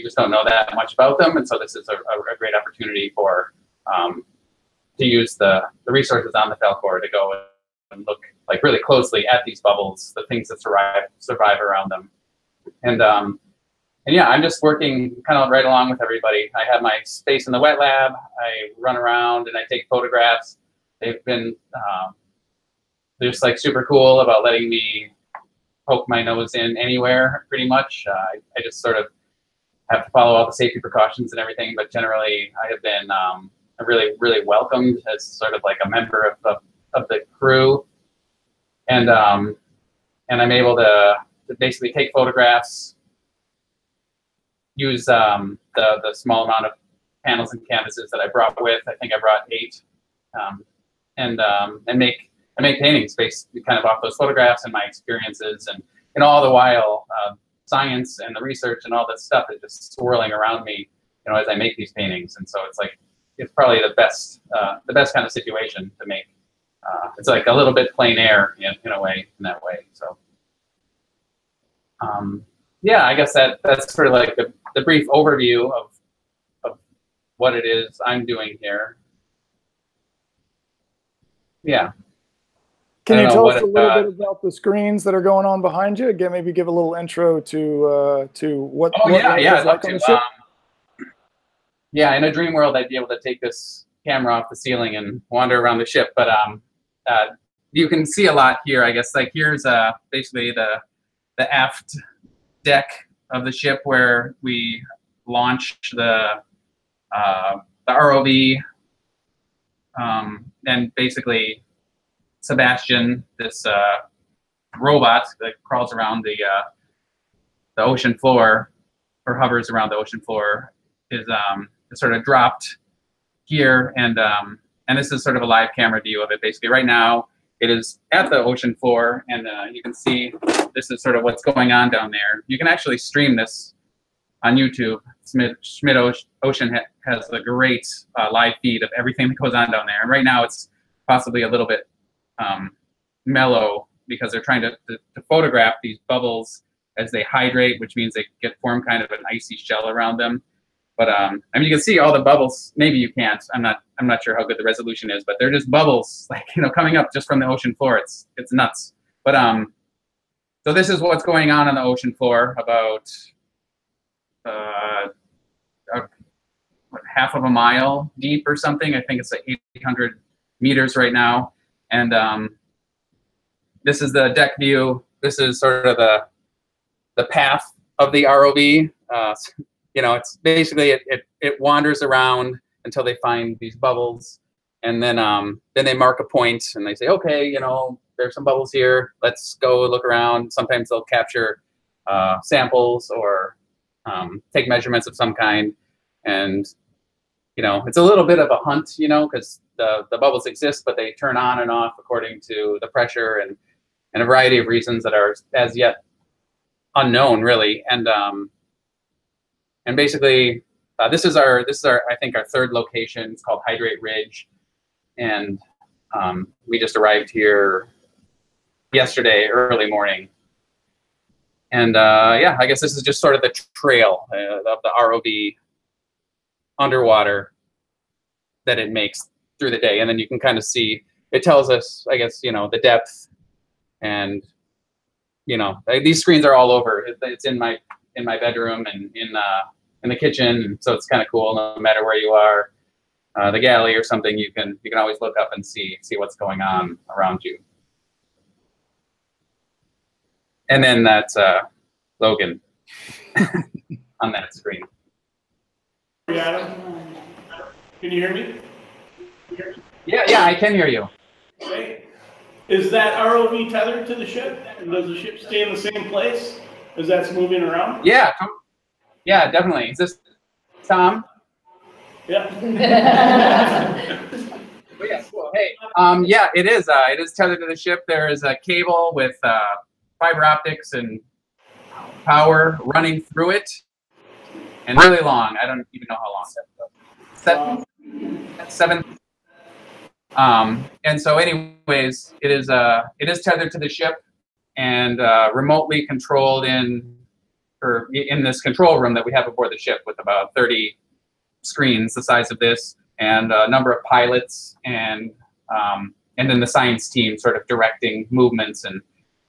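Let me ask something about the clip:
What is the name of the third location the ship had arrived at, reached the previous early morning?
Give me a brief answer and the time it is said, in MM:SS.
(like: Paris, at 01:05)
Hydrate Ridge, at 03:33.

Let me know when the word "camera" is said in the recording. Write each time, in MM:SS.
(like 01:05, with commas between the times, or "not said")
01:34, 02:05.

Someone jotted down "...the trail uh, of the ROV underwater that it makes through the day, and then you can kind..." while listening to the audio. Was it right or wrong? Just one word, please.
right.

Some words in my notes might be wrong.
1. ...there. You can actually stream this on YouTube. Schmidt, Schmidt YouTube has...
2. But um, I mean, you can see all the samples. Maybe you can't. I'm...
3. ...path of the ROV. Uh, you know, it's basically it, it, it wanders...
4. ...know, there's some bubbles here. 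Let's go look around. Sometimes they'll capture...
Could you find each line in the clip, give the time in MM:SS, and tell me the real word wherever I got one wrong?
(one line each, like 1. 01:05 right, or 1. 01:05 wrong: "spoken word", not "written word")
1. 02:12 wrong: "Ocean", not "YouTube"
2. 02:30 wrong: "bubbles", not "samples"
3. 02:57 right
4. 03:07 right.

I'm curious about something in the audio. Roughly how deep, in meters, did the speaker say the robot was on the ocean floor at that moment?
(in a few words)
800 meters.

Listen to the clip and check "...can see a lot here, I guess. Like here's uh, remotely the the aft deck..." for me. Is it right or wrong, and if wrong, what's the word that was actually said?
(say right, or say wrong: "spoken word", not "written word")
wrong: "basically", not "remotely".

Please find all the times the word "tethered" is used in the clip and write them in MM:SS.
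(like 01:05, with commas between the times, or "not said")
04:23, 04:37, 04:53.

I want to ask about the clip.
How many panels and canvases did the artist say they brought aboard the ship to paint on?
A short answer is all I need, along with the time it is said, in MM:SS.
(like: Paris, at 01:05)
8, at 00:49.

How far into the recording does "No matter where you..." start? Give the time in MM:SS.
04:01.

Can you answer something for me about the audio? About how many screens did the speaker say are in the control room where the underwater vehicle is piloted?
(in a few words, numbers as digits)
30.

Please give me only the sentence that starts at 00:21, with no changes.
They've been um, they're just like super cool about letting me poke my nose in anywhere, pretty much.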